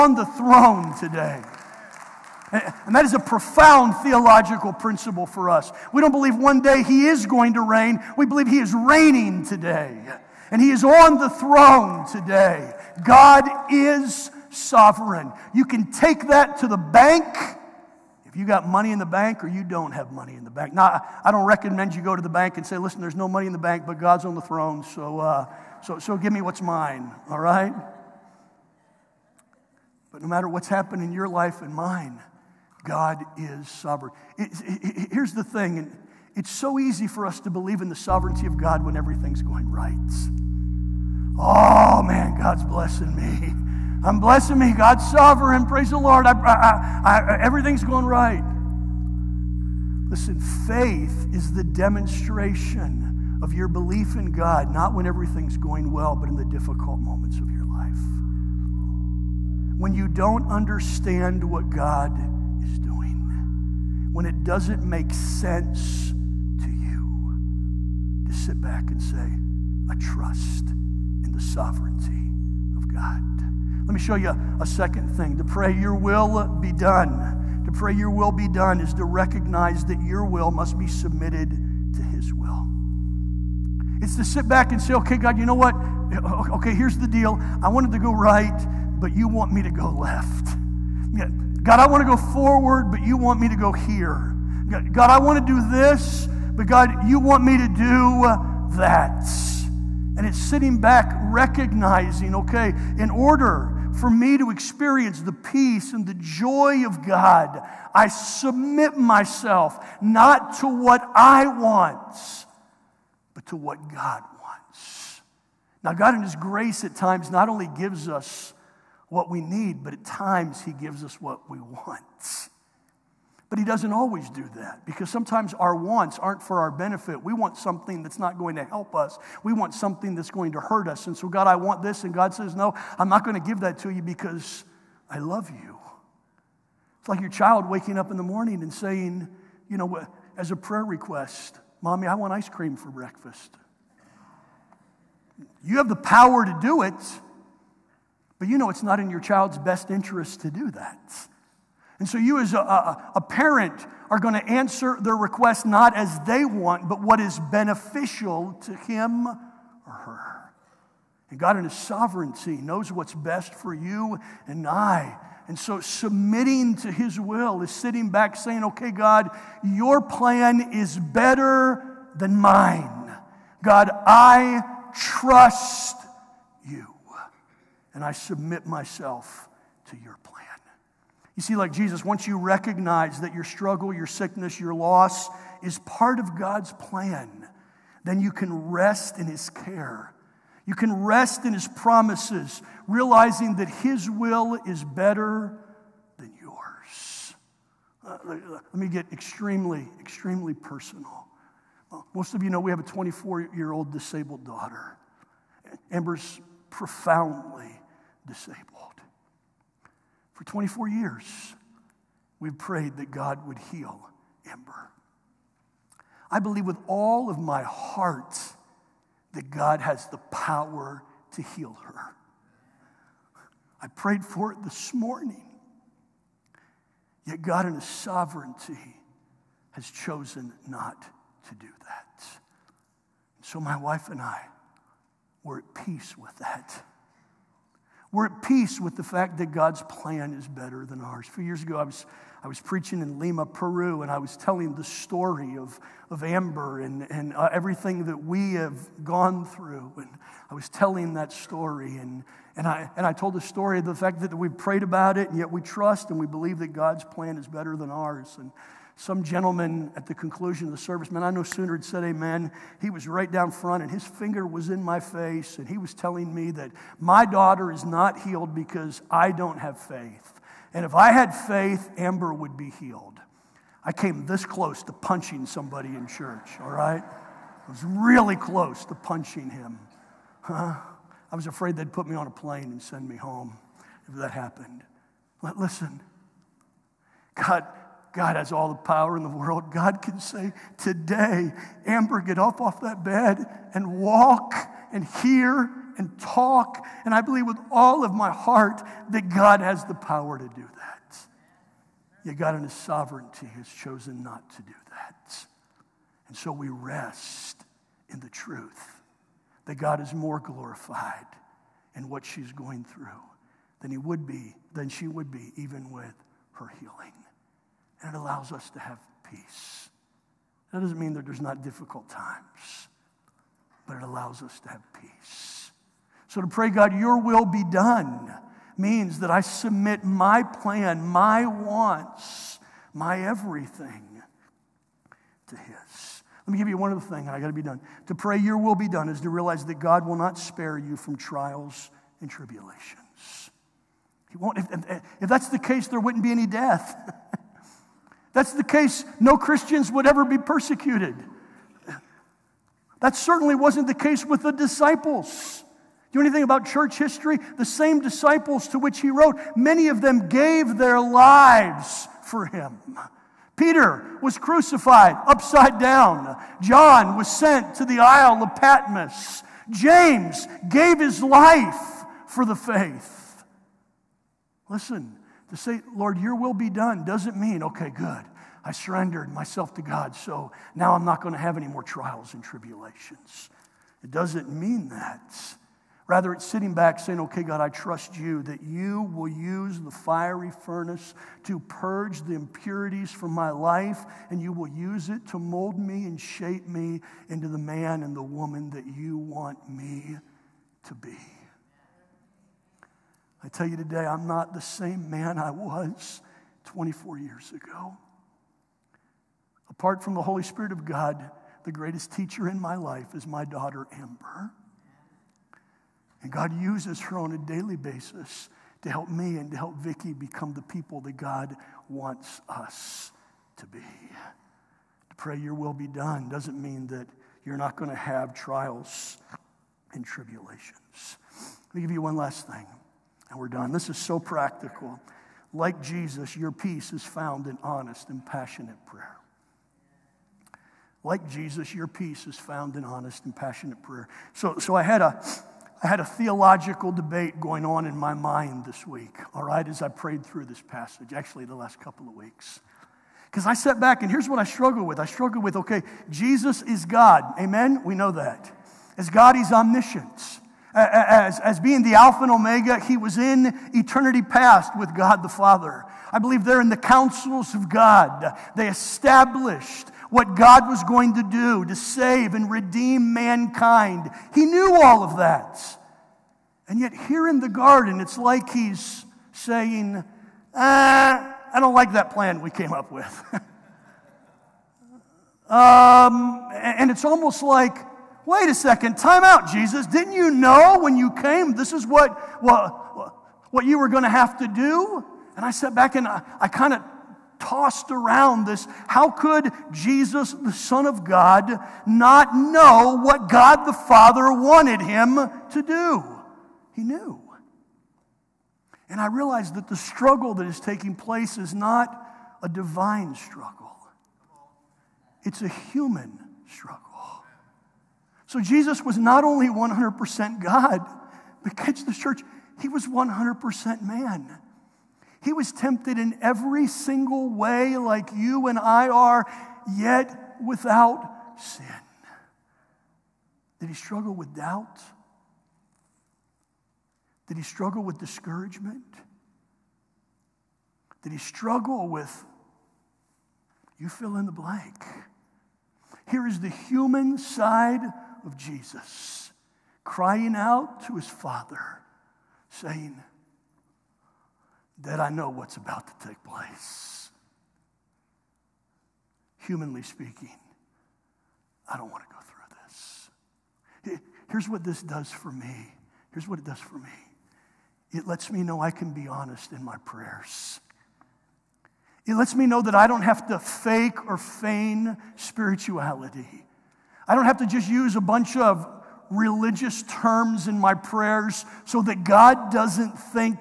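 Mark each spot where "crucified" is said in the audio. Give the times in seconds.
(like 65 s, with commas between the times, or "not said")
364 s.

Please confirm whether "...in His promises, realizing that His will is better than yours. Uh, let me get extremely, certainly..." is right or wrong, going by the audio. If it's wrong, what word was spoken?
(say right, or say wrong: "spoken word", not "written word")
wrong: "extremely", not "certainly".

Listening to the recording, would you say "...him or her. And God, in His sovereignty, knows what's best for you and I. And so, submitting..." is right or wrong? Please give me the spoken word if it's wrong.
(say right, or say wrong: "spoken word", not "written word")
right.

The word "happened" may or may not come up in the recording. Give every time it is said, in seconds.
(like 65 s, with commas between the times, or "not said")
30 s, 284 s.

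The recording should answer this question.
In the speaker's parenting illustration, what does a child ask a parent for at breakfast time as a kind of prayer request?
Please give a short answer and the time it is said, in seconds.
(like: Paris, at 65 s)
Ice cream, at 142 s.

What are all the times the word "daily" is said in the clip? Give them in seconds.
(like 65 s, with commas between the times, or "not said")
417 s.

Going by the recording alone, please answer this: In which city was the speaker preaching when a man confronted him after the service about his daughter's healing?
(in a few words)
Lima.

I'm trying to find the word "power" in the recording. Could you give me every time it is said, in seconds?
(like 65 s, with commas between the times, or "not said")
145 s, 220 s, 288 s, 299 s.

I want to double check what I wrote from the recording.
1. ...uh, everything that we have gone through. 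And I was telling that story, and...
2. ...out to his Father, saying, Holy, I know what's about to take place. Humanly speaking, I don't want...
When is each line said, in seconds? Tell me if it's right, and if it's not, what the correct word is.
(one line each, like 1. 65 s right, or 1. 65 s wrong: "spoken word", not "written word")
1. 247 s right
2. 550 s wrong: "Dad", not "Holy".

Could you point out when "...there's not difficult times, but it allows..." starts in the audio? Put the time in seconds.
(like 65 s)
321 s.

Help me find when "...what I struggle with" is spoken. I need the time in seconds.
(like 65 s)
454 s.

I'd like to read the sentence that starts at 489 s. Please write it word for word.
Didn't you know when you came this is what, what, what you were going to have to do?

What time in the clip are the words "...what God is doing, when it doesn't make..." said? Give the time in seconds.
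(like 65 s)
61 s.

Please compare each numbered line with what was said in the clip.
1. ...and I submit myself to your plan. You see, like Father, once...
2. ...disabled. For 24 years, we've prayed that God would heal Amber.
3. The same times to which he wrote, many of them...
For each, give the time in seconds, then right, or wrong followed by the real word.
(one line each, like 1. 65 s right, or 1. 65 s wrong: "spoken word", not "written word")
1. 177 s wrong: "Jesus", not "Father"
2. 208 s right
3. 357 s wrong: "disciples", not "times".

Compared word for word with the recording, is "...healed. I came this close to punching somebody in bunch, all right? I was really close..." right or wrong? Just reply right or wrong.
wrong.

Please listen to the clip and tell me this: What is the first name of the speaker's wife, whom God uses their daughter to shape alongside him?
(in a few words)
Vicky.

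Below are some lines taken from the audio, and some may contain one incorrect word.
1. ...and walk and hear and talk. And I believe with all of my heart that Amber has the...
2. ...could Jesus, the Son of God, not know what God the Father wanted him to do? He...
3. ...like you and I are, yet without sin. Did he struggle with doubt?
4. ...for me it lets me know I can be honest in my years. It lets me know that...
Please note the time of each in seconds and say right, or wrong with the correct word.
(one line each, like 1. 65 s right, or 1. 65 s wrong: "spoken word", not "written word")
1. 293 s wrong: "God", not "Amber"
2. 499 s right
3. 527 s right
4. 566 s wrong: "prayers", not "years".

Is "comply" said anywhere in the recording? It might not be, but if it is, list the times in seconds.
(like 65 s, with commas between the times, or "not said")
not said.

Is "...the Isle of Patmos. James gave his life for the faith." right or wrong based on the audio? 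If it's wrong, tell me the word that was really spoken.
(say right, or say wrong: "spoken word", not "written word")
right.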